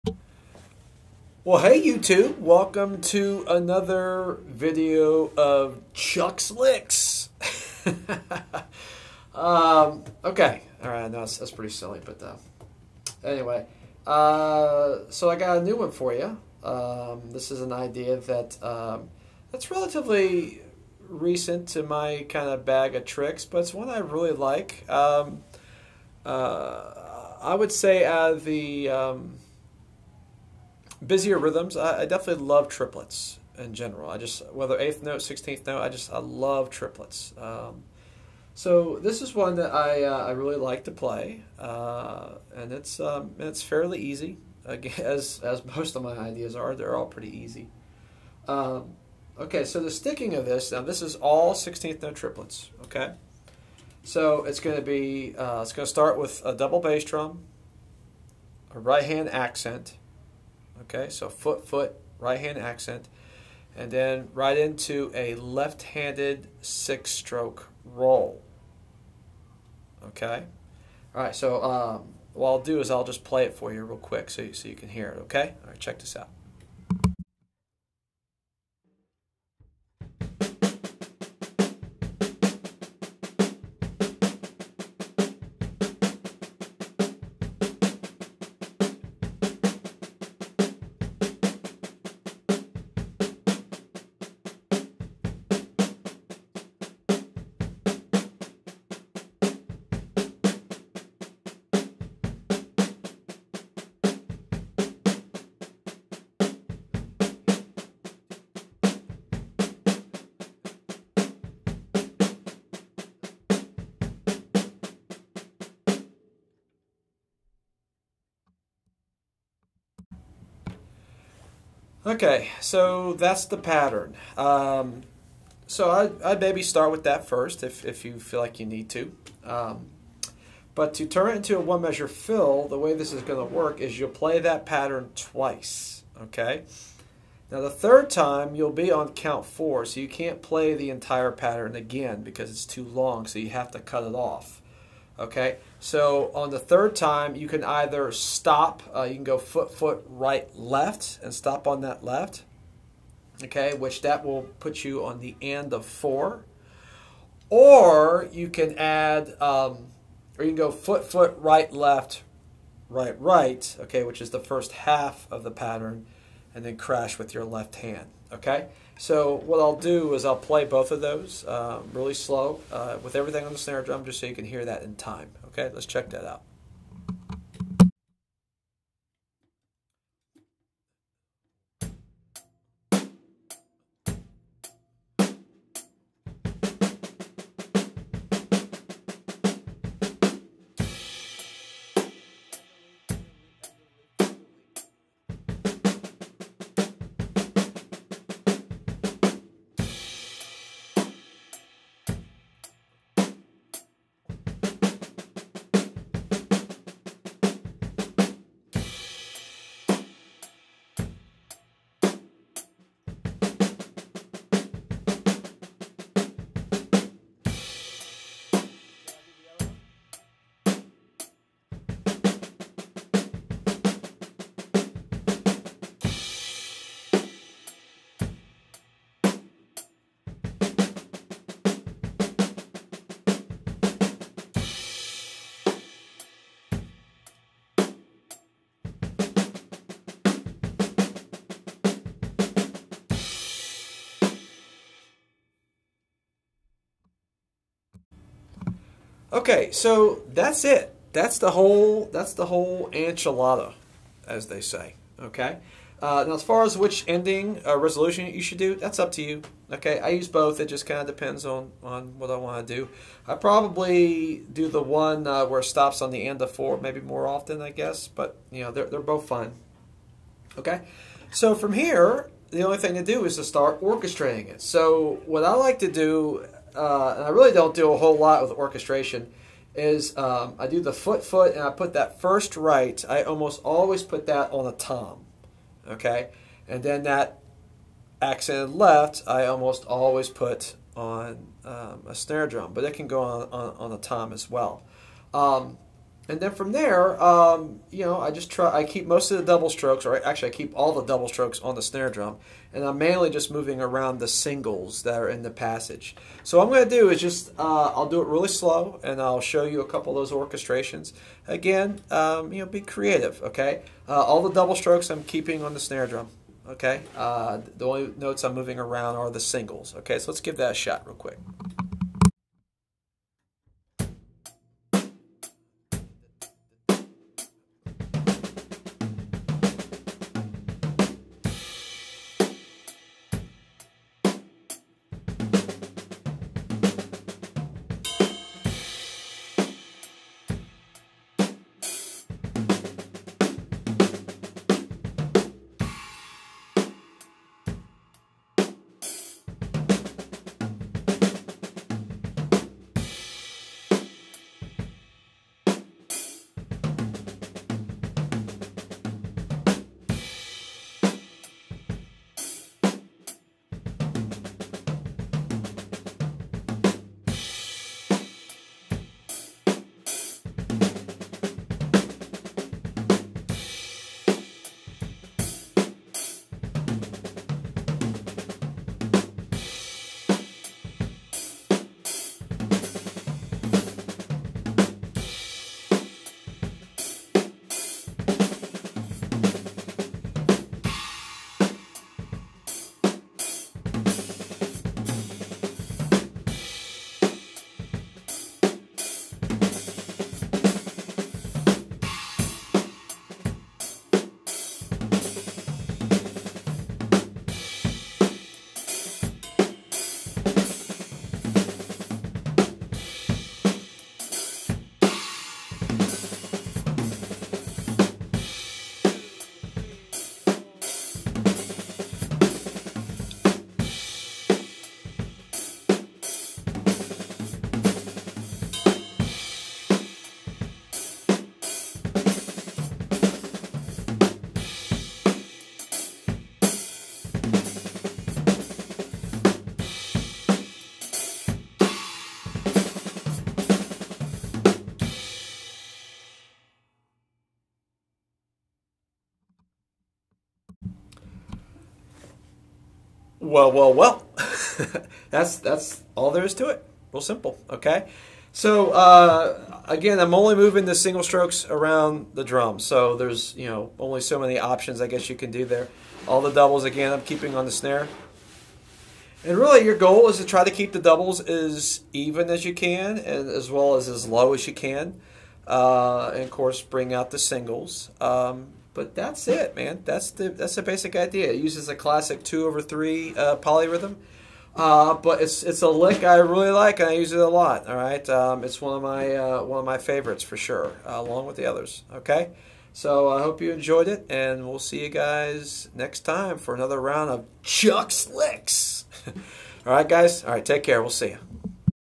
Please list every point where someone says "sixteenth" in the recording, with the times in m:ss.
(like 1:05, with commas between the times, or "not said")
0:35, 0:51.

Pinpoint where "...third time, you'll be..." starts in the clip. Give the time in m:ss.
2:17.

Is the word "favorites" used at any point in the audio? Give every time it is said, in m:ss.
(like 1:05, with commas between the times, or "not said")
8:09.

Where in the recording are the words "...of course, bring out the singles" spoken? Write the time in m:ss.
7:56.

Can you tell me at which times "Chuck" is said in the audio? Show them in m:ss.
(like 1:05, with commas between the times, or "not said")
0:05, 8:17.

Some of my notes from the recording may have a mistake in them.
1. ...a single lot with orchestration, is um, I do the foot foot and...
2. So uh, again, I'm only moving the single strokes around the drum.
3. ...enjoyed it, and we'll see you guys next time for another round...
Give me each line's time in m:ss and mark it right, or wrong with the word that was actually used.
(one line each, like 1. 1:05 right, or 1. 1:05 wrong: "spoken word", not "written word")
1. 4:37 wrong: "whole", not "single"
2. 7:38 right
3. 8:13 right.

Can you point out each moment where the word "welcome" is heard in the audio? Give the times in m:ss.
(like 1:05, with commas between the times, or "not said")
0:02.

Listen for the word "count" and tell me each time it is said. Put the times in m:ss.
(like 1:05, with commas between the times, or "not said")
2:19.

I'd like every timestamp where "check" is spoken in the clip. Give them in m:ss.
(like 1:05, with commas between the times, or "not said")
1:15, 2:55.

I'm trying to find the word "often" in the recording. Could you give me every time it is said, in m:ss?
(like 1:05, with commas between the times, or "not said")
4:27.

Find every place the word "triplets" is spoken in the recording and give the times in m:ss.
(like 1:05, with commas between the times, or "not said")
0:32, 0:36, 0:52.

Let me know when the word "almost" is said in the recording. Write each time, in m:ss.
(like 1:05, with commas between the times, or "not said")
4:43, 4:49.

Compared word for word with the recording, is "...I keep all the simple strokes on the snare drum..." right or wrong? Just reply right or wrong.
wrong.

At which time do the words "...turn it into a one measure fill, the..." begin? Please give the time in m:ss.
2:11.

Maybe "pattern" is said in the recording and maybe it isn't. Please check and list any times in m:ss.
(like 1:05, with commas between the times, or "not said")
2:03, 2:14, 2:21, 2:45.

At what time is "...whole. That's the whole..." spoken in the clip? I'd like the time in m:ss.
4:11.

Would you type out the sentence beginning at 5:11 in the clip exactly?
Again, um, you know, be creative.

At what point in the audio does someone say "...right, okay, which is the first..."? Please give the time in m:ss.
2:43.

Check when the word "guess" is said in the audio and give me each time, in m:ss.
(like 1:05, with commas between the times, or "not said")
4:27, 7:45.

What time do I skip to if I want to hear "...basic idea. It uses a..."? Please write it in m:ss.
8:00.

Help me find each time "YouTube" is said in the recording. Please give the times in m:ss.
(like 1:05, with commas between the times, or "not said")
0:01.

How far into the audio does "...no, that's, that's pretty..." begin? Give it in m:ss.
0:11.